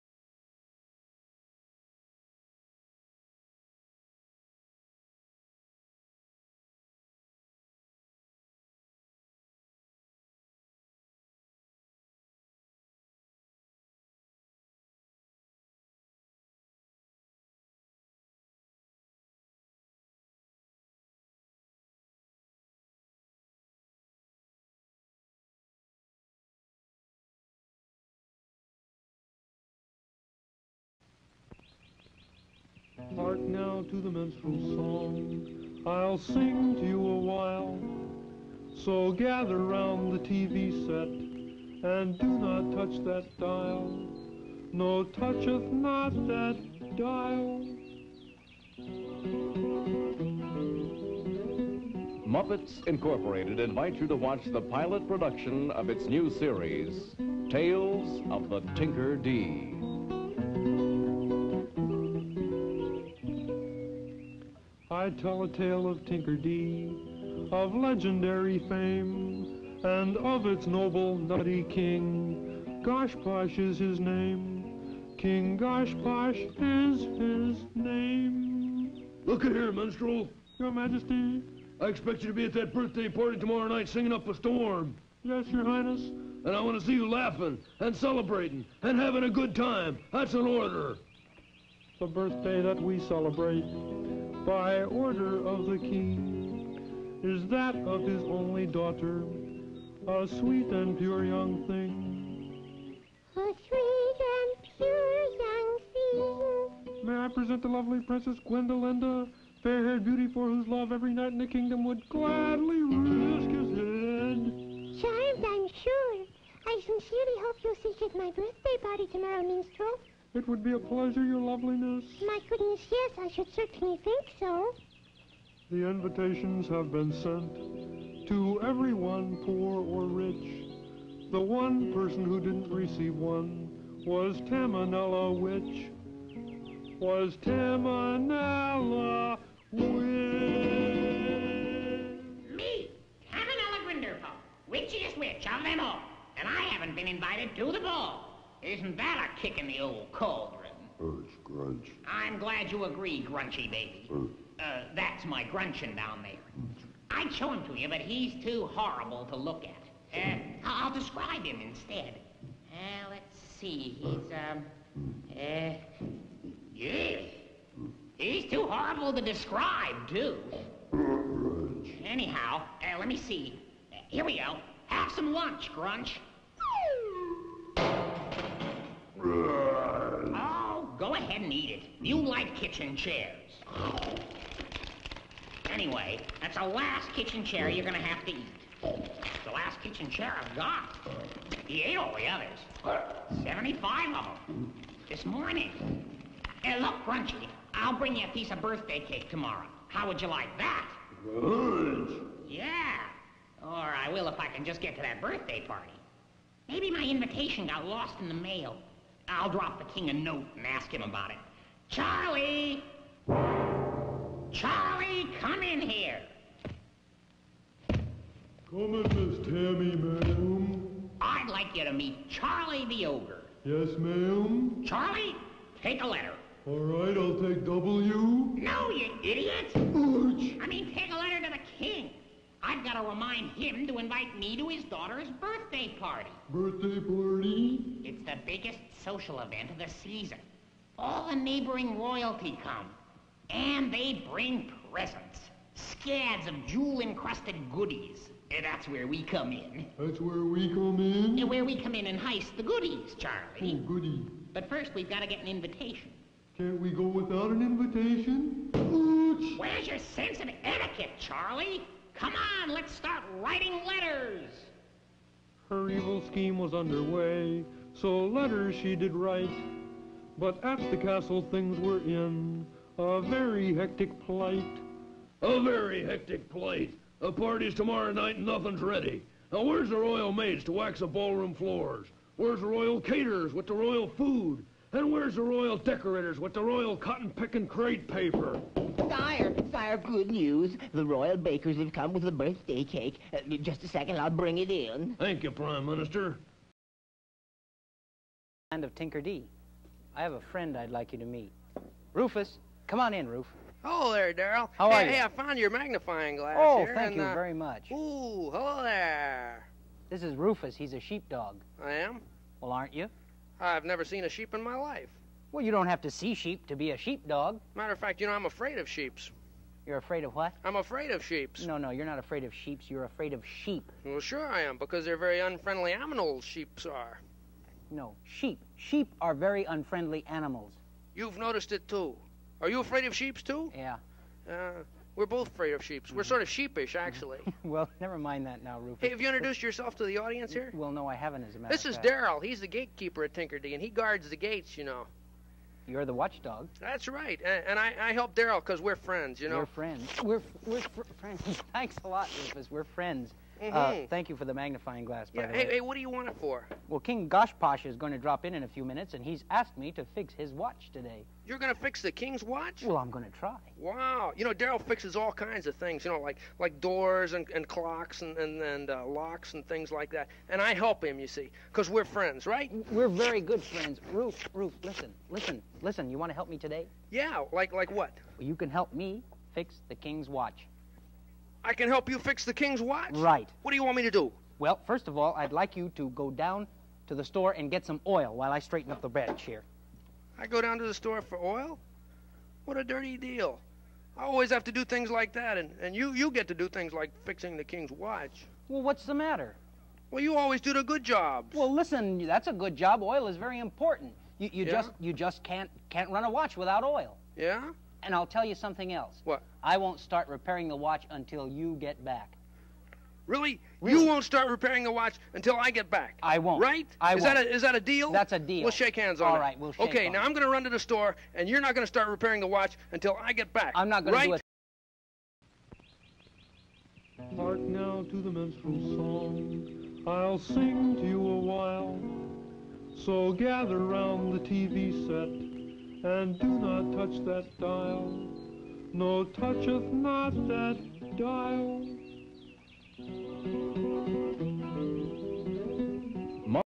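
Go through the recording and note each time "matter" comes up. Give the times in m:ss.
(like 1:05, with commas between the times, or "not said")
5:17, 5:41, 6:39.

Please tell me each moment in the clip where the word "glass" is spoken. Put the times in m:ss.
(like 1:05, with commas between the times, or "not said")
5:06, 5:55.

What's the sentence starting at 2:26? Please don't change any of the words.
And I haven't been invited to the ball.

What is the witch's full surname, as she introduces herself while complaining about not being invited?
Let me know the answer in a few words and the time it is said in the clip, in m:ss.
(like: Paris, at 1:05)
Grinderpaw, at 2:23.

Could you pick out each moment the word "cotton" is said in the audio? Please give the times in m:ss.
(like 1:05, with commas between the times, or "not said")
4:46.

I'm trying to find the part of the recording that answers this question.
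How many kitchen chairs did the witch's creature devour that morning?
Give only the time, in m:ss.
3:13.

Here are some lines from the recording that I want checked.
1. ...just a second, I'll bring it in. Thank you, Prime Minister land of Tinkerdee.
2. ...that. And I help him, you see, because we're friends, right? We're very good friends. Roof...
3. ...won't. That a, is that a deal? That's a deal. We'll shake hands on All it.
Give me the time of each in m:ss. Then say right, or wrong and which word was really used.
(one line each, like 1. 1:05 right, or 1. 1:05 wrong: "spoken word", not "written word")
1. 4:53 right
2. 6:10 right
3. 6:57 right.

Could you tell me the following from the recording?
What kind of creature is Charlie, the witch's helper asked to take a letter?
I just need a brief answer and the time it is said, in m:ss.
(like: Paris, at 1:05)
Ogre, at 3:42.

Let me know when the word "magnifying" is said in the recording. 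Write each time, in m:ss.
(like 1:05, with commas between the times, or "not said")
5:05, 5:54.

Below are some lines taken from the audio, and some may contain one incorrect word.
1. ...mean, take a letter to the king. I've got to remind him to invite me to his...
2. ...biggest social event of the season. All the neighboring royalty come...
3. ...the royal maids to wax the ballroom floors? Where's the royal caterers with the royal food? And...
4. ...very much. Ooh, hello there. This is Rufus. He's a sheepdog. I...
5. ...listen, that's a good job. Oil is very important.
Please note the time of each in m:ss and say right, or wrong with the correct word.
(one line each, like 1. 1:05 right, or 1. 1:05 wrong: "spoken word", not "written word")
1. 3:50 right
2. 3:58 right
3. 4:39 right
4. 5:07 right
5. 6:41 right.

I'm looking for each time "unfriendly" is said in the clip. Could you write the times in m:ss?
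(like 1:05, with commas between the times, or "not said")
5:25, 5:29.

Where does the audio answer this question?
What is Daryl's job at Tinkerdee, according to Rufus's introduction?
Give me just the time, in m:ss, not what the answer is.
5:42.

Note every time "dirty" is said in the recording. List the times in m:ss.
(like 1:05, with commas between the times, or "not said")
6:32.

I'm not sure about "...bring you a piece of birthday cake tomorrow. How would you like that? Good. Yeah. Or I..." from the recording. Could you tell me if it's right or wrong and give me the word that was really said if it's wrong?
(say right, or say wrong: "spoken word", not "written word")
right.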